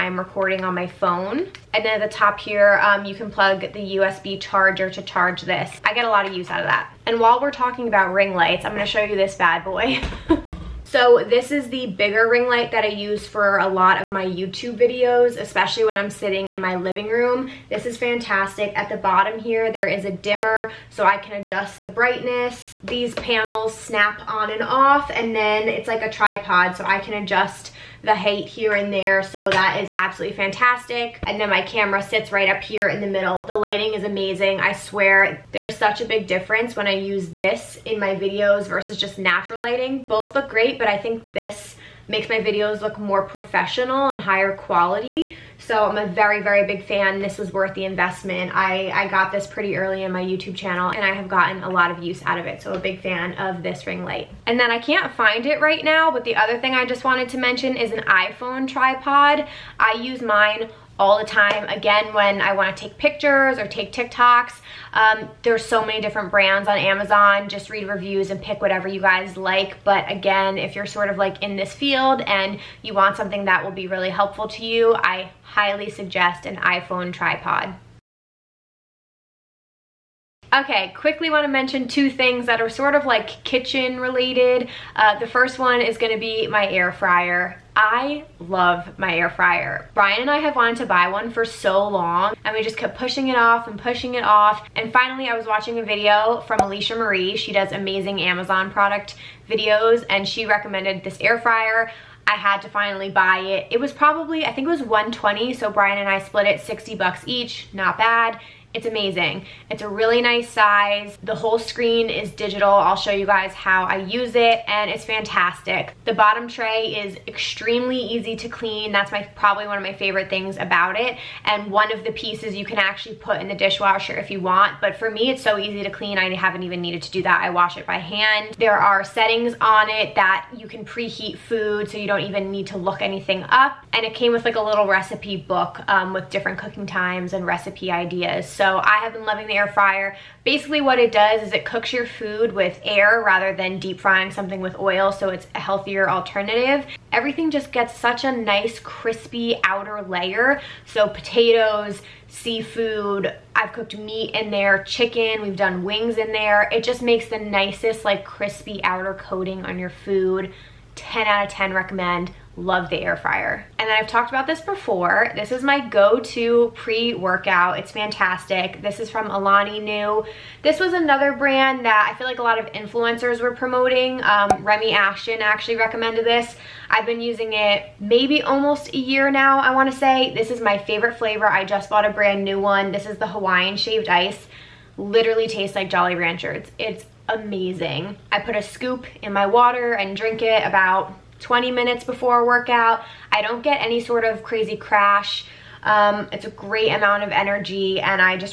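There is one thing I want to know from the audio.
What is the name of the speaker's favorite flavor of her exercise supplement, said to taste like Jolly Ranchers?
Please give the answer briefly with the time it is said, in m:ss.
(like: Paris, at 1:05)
Hawaiian Shaved Ice, at 3:03.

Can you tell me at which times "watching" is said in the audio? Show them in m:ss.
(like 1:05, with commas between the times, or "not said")
1:35.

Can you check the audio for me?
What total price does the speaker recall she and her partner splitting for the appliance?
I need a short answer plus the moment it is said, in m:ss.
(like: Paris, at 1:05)
120, at 1:44.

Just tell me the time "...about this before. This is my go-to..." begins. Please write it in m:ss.
2:44.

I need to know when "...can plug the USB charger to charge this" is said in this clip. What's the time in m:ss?
0:03.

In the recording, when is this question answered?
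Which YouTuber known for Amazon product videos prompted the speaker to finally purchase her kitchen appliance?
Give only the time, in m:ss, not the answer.
1:36.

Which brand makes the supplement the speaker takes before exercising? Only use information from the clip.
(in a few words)
Alani Nu.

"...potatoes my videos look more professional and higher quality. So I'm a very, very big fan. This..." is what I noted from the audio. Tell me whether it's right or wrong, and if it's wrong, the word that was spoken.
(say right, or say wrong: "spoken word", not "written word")
wrong: "makes", not "potatoes".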